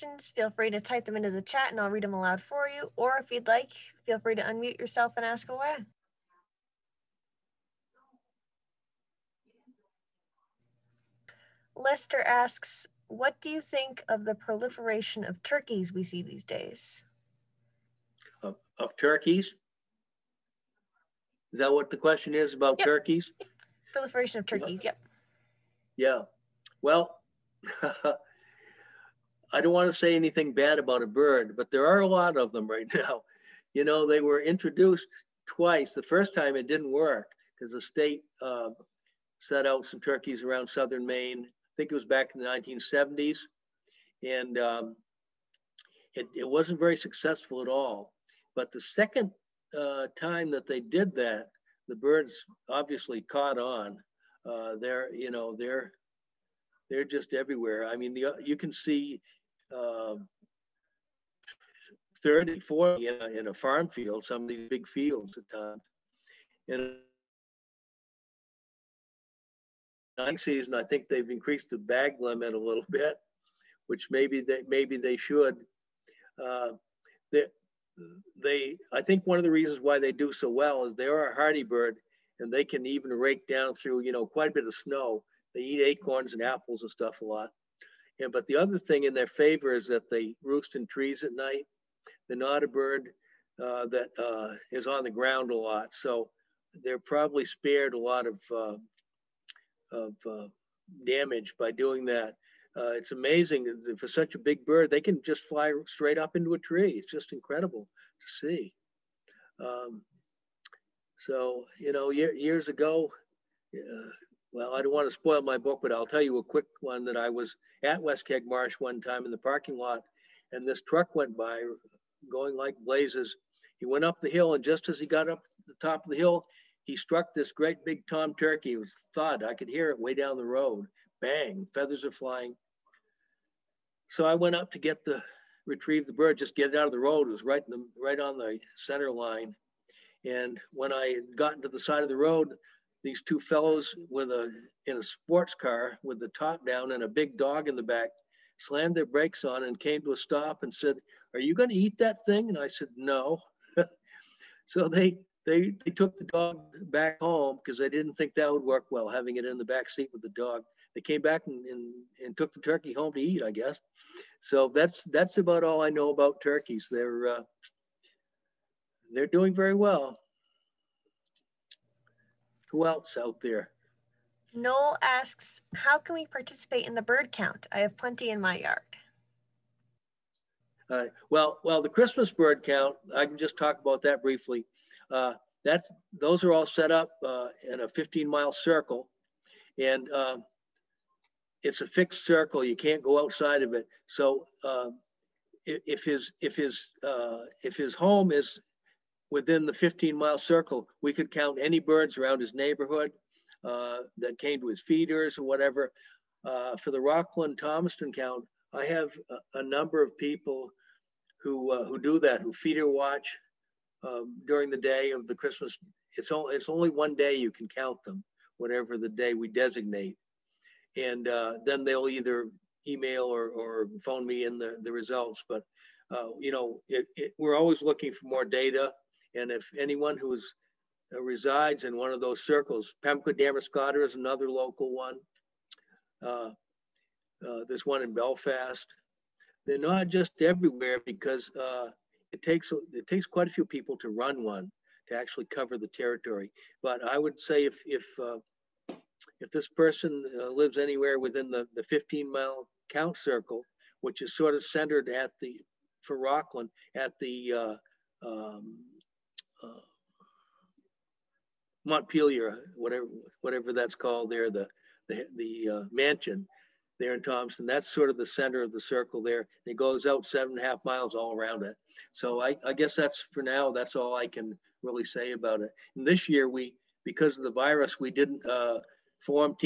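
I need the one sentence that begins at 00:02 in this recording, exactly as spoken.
Or if you'd like, feel free to unmute yourself and ask away.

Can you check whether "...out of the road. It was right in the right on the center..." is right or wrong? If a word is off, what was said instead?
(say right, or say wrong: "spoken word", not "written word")
right.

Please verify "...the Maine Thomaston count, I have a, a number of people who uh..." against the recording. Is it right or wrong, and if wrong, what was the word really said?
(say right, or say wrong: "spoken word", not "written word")
wrong: "Rockland", not "Maine".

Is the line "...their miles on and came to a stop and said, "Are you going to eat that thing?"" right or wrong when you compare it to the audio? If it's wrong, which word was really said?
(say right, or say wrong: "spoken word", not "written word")
wrong: "brakes", not "miles".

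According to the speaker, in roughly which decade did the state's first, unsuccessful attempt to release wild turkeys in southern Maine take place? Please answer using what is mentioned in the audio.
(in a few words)
1970s.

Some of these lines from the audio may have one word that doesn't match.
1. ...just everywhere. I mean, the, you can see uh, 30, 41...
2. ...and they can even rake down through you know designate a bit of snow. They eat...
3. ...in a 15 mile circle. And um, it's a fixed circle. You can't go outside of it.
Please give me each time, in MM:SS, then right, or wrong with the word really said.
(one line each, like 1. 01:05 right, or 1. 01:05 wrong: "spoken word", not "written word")
1. 00:57 wrong: "40", not "41"
2. 01:22 wrong: "quite", not "designate"
3. 03:07 right.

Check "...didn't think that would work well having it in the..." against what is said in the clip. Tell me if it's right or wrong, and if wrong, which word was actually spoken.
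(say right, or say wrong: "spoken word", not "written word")
right.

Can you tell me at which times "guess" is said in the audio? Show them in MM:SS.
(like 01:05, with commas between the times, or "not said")
02:43, 04:32.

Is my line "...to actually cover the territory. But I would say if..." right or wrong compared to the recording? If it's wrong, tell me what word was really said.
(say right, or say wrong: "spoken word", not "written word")
right.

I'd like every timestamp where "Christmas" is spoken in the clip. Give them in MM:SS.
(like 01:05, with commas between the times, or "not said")
03:01, 03:35.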